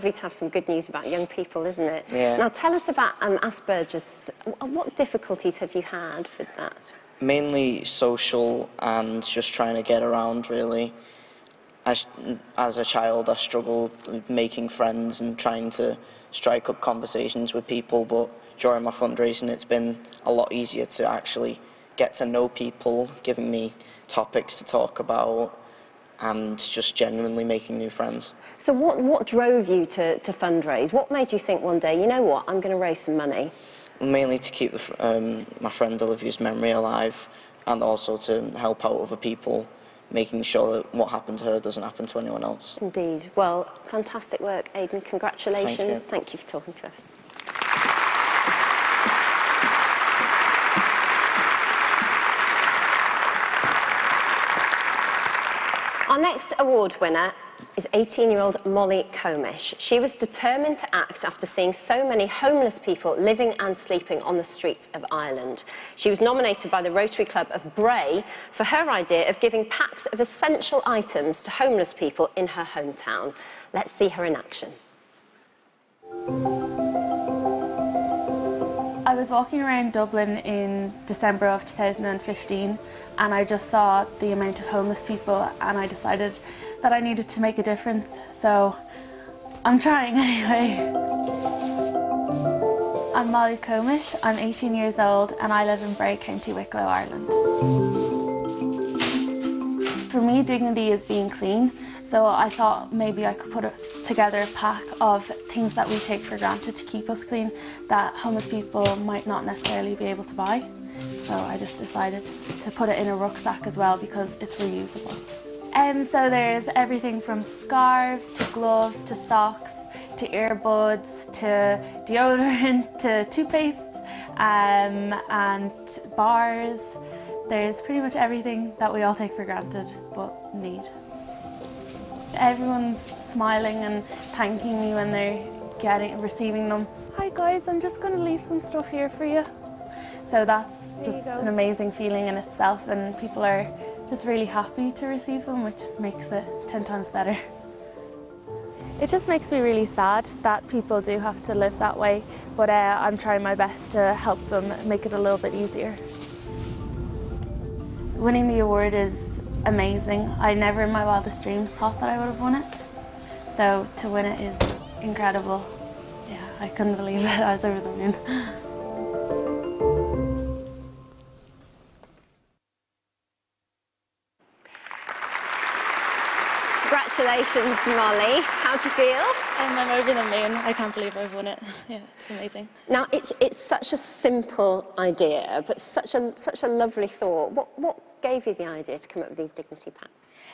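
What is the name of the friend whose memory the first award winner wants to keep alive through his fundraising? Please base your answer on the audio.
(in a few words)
Olivia.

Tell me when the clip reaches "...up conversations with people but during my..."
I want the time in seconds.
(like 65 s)
16 s.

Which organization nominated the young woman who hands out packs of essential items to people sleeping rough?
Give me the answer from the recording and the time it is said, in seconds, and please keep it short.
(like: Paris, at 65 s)
Rotary Club of Bray, at 66 s.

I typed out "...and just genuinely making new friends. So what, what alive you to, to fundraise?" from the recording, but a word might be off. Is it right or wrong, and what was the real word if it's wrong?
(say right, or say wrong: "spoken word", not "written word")
wrong: "drove", not "alive".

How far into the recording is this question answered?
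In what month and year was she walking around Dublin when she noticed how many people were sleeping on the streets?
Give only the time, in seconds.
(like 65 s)
81 s.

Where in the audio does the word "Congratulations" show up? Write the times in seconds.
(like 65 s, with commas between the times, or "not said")
45 s, 176 s.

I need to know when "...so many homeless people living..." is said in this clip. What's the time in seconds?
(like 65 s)
61 s.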